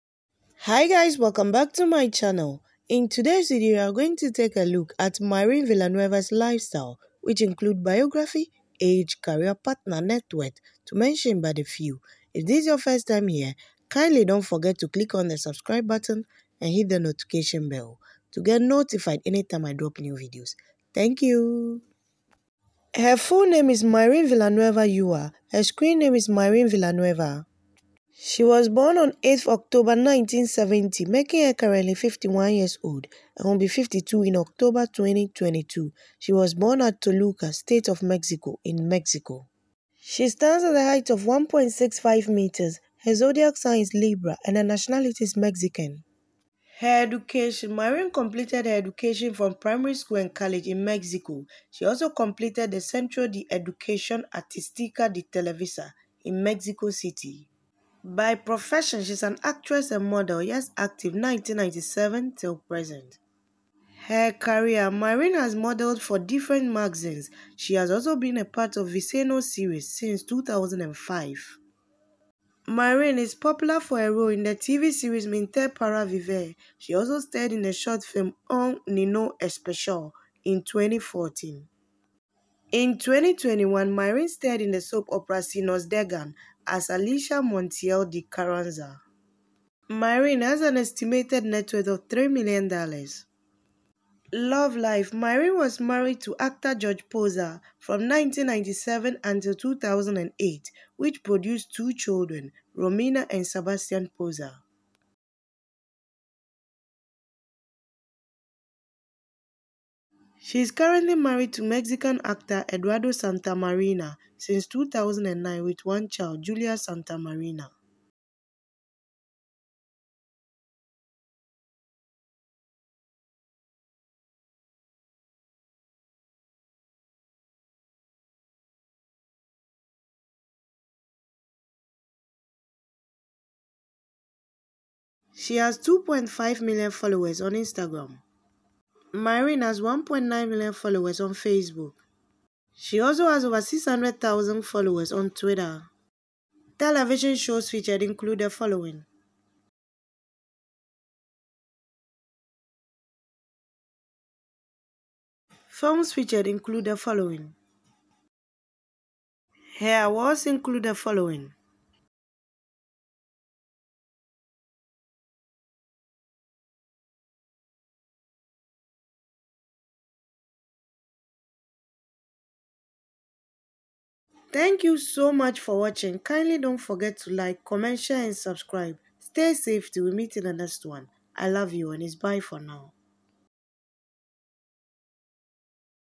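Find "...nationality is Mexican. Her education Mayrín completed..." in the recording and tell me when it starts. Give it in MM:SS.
00:44.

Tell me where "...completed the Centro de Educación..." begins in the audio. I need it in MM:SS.
00:52.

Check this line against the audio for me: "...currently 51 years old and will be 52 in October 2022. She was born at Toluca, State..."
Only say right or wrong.
right.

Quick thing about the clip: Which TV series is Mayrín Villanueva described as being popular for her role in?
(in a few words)
Mentir Para Vivir.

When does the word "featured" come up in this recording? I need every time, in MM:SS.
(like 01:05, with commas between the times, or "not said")
02:27, 02:36.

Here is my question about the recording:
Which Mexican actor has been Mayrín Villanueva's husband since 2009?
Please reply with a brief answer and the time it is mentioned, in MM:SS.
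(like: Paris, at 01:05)
Eduardo Santamarina, at 01:52.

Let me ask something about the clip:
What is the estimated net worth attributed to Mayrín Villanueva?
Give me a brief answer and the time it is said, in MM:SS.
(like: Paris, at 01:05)
$3 million, at 01:32.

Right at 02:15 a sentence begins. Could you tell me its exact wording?
She has 2.5 million followers on Instagram.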